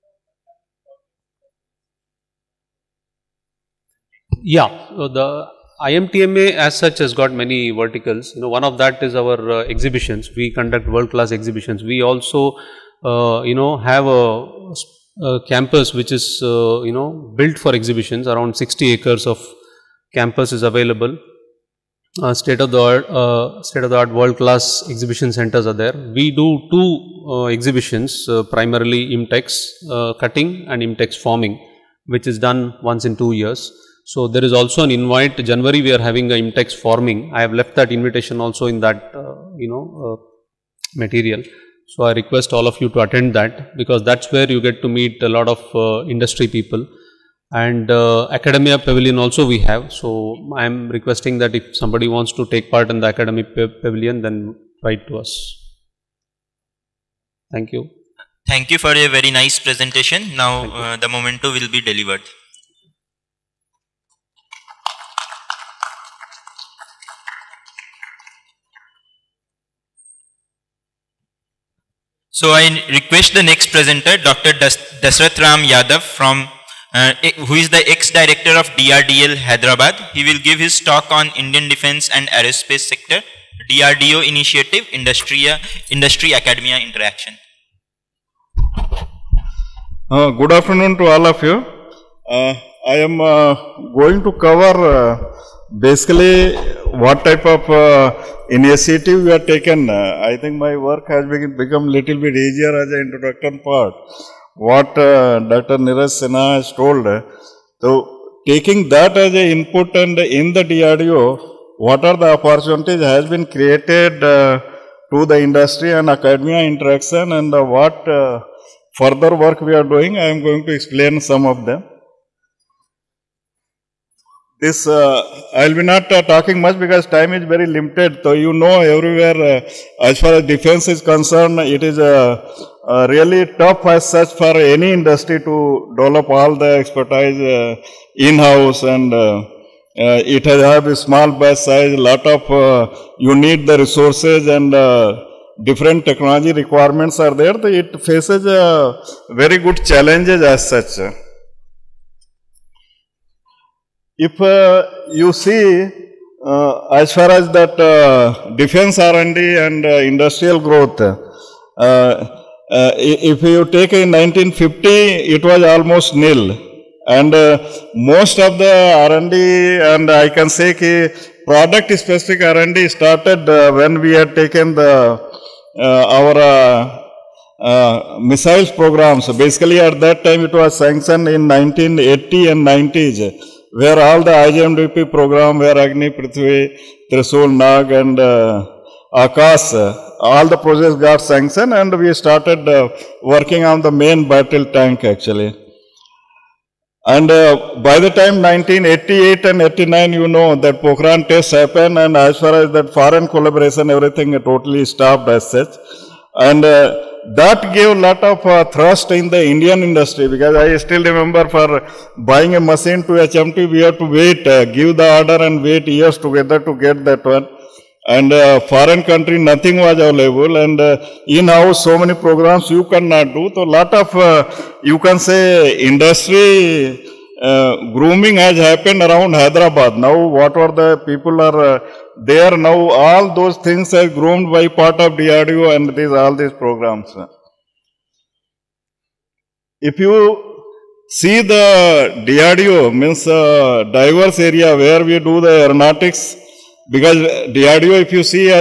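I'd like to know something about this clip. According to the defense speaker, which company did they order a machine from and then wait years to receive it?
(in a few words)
HMT.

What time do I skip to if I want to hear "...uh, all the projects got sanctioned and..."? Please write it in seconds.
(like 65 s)
189 s.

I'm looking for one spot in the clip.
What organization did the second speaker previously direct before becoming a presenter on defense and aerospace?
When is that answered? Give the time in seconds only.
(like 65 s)
78 s.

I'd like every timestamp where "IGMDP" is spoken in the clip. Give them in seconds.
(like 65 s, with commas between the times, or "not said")
184 s.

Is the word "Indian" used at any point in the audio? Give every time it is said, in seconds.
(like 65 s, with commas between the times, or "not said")
81 s, 209 s.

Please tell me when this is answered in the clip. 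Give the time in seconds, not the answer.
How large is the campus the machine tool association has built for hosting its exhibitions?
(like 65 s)
18 s.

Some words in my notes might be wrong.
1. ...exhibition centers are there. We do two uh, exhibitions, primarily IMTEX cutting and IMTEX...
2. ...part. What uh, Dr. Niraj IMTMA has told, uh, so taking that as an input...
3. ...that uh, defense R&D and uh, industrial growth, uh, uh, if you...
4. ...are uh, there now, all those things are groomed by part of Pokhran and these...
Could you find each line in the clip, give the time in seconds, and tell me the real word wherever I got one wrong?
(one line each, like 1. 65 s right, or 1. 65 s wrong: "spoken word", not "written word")
1. 24 s right
2. 103 s wrong: "Sinha", not "IMTMA"
3. 157 s right
4. 231 s wrong: "DRDO", not "Pokhran".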